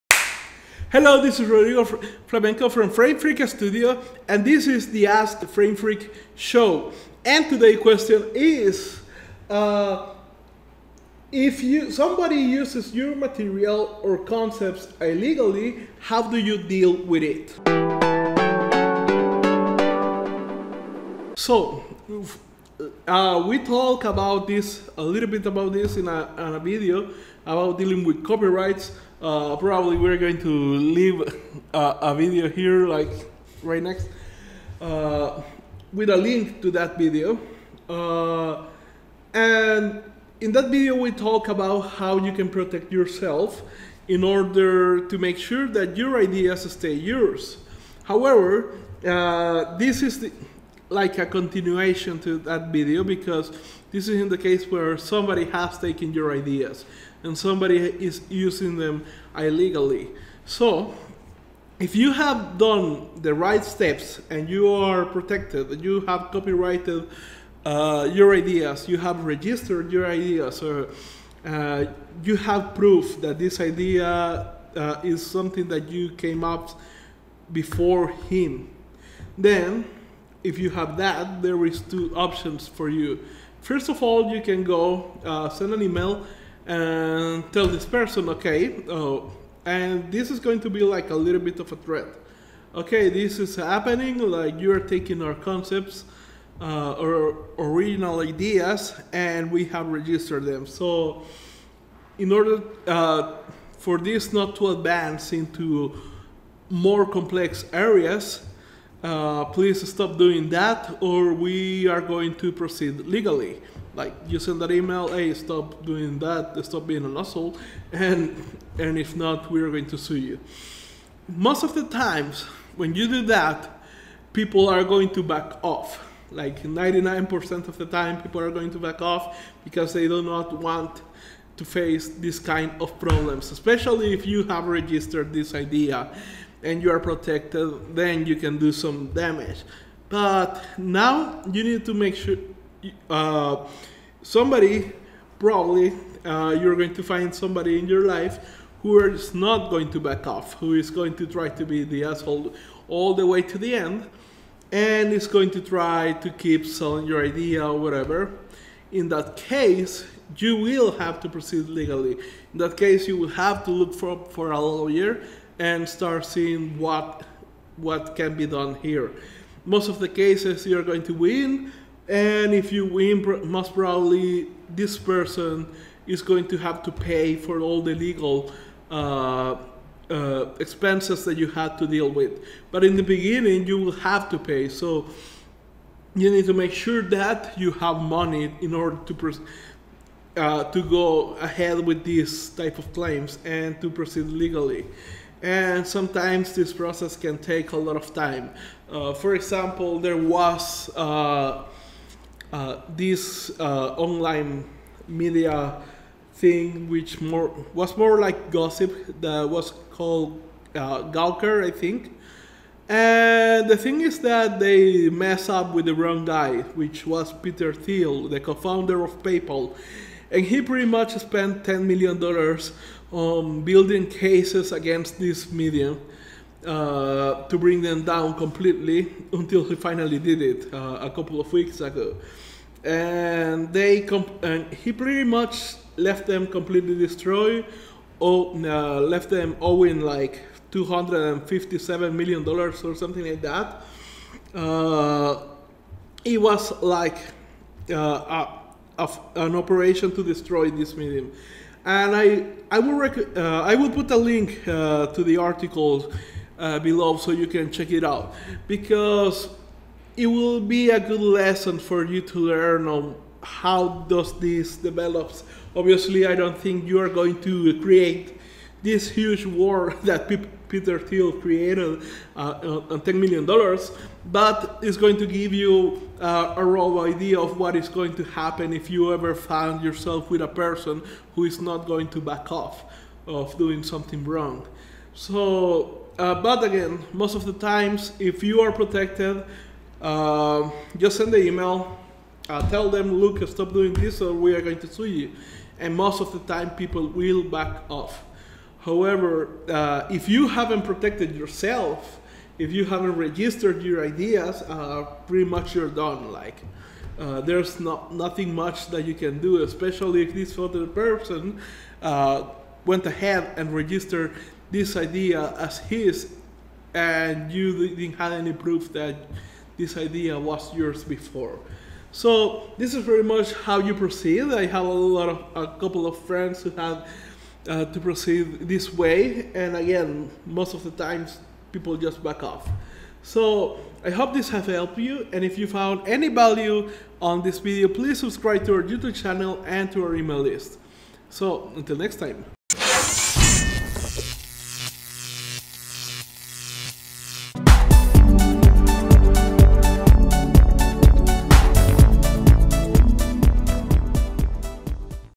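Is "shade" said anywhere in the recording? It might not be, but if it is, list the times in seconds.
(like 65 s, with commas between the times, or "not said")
not said.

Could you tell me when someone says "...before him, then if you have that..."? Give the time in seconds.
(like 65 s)
77 s.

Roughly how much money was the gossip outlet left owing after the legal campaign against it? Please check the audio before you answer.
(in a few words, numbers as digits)
257 million dollars.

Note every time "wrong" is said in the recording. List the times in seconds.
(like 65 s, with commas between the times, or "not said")
215 s, 284 s.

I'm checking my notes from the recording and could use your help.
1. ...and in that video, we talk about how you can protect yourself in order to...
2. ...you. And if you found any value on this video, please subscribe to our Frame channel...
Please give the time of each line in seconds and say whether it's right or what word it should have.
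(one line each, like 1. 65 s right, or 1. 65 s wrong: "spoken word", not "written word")
1. 39 s right
2. 334 s wrong: "YouTube", not "Frame".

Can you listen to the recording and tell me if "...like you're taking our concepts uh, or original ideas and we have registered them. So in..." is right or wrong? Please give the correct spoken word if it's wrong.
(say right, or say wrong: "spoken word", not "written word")
right.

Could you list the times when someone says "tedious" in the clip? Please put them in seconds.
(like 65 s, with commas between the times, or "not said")
not said.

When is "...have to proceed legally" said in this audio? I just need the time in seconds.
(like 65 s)
160 s.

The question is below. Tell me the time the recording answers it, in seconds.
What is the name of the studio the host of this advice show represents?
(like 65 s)
2 s.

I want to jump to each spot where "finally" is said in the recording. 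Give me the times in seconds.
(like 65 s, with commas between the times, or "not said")
229 s.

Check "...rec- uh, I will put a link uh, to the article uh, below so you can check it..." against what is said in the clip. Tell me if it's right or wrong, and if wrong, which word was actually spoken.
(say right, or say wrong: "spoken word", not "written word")
right.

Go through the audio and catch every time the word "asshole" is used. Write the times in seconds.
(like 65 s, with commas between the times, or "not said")
117 s, 152 s.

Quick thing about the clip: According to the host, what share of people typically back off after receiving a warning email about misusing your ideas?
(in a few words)
99%.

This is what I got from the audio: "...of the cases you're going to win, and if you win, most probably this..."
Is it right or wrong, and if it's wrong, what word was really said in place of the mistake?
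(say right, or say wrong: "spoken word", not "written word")
right.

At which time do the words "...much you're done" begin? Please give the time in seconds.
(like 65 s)
305 s.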